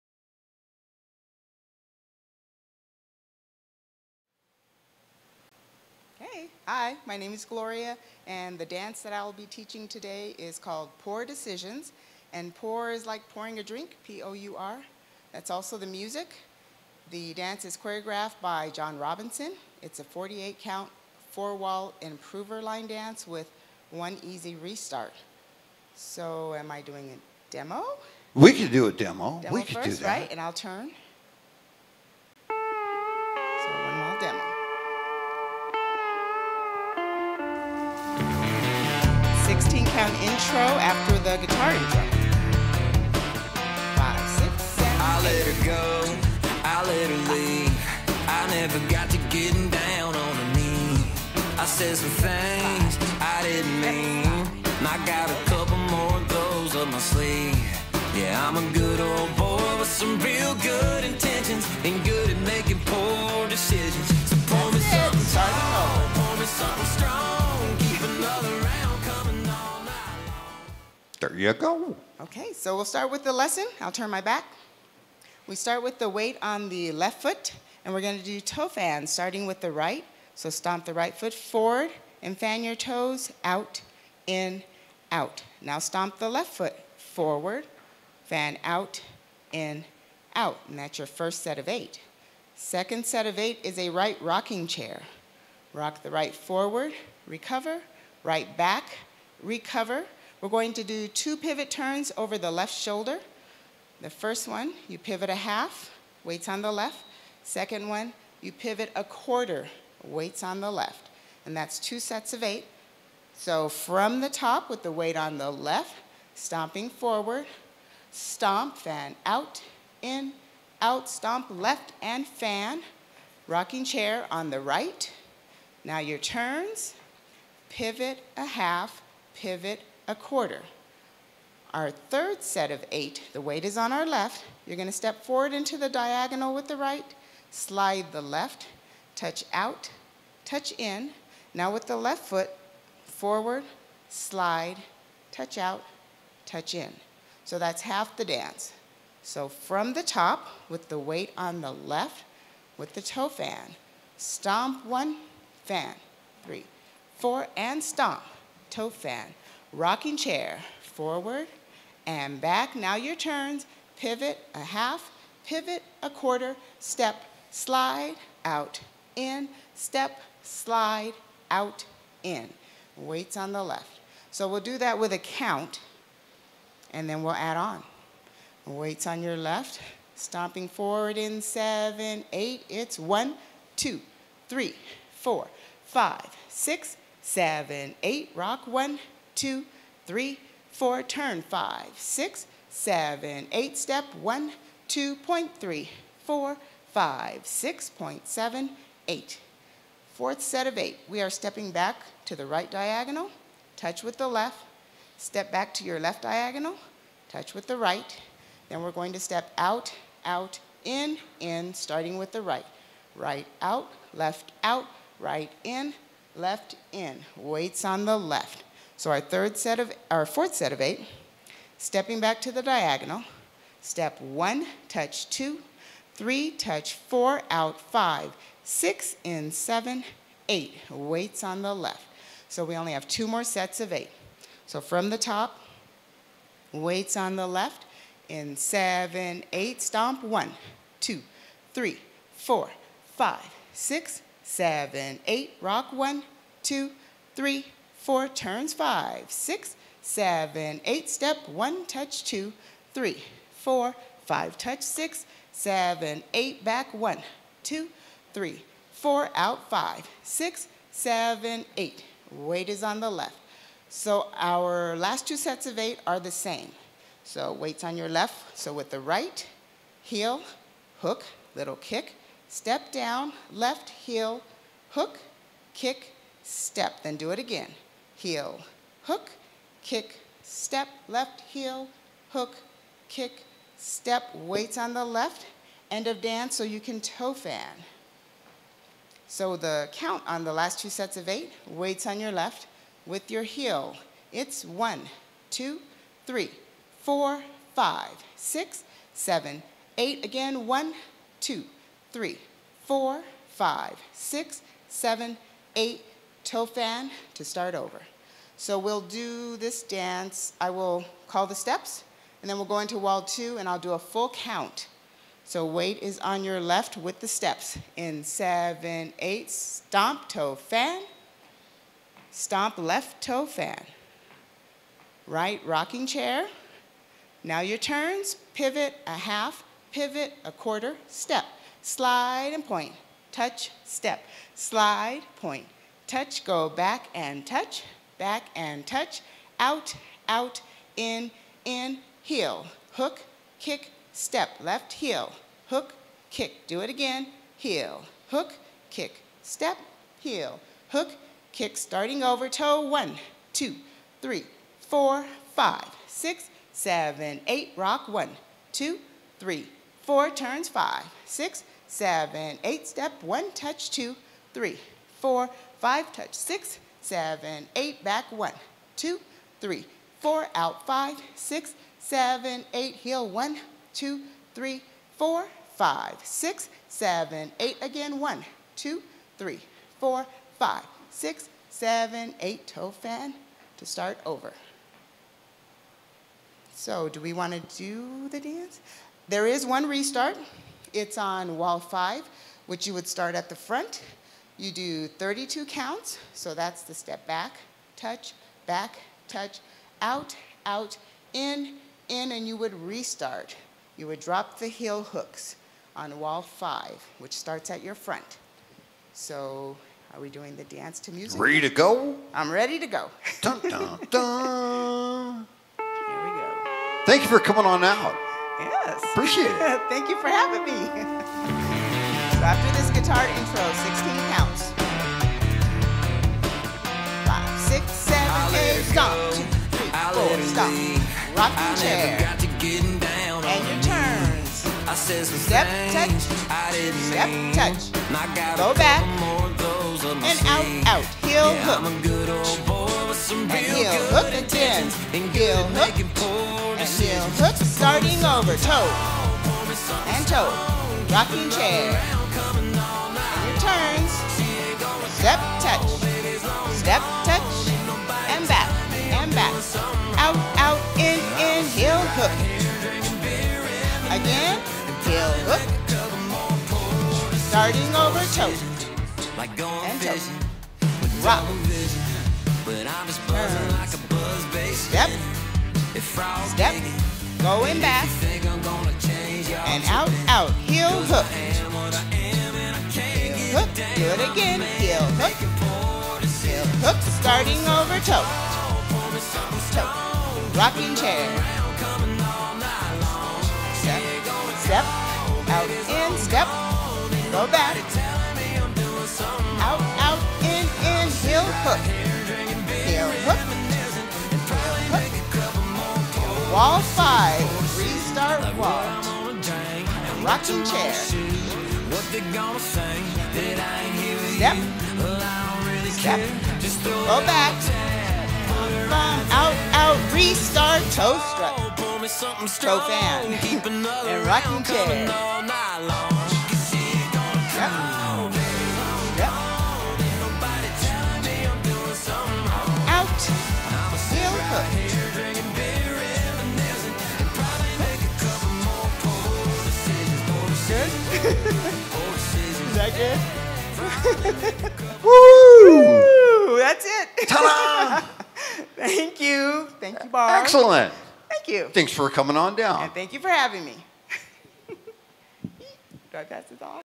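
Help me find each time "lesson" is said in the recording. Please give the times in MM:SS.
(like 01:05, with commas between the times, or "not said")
01:13.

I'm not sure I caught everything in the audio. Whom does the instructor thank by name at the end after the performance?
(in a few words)
Barb.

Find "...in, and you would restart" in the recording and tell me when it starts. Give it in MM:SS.
06:42.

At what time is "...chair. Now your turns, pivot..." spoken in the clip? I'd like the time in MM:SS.
05:26.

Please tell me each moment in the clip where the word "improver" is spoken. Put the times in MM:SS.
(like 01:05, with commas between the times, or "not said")
00:21.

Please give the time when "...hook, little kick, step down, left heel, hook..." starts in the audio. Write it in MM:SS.
04:31.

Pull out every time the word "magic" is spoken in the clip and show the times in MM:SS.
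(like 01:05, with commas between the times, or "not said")
not said.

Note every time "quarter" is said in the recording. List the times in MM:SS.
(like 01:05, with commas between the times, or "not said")
01:49, 02:10, 02:46, 05:30.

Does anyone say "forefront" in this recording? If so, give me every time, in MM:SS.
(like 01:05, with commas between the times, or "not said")
not said.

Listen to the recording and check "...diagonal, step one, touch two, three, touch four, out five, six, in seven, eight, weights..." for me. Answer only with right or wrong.
right.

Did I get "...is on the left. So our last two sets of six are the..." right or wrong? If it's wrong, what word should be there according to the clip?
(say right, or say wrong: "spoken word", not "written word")
wrong: "eight", not "six".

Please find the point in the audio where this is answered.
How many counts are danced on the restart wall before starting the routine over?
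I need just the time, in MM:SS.
06:35.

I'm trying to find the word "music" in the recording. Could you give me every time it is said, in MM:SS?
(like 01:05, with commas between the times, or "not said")
00:15, 06:51.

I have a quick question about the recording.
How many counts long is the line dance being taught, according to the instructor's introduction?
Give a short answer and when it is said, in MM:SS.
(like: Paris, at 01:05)
48, at 00:20.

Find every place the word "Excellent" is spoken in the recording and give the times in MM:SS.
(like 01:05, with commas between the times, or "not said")
09:10.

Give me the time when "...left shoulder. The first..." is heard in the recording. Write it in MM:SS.
01:42.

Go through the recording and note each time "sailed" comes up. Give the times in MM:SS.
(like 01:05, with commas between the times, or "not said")
not said.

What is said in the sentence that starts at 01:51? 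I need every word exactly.
And that's two sets of eight.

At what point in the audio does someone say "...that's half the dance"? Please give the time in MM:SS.
02:27.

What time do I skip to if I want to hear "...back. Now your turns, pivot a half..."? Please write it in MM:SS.
02:42.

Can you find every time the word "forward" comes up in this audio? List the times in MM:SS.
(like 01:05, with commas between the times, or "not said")
01:21, 01:26, 01:36, 01:56, 02:15, 02:23, 02:40, 03:00.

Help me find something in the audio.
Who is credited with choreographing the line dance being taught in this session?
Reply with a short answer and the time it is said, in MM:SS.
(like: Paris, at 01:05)
John Robinson, at 00:18.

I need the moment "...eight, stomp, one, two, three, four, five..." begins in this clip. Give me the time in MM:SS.
03:59.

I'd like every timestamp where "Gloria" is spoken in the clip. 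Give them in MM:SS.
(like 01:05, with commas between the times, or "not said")
00:07.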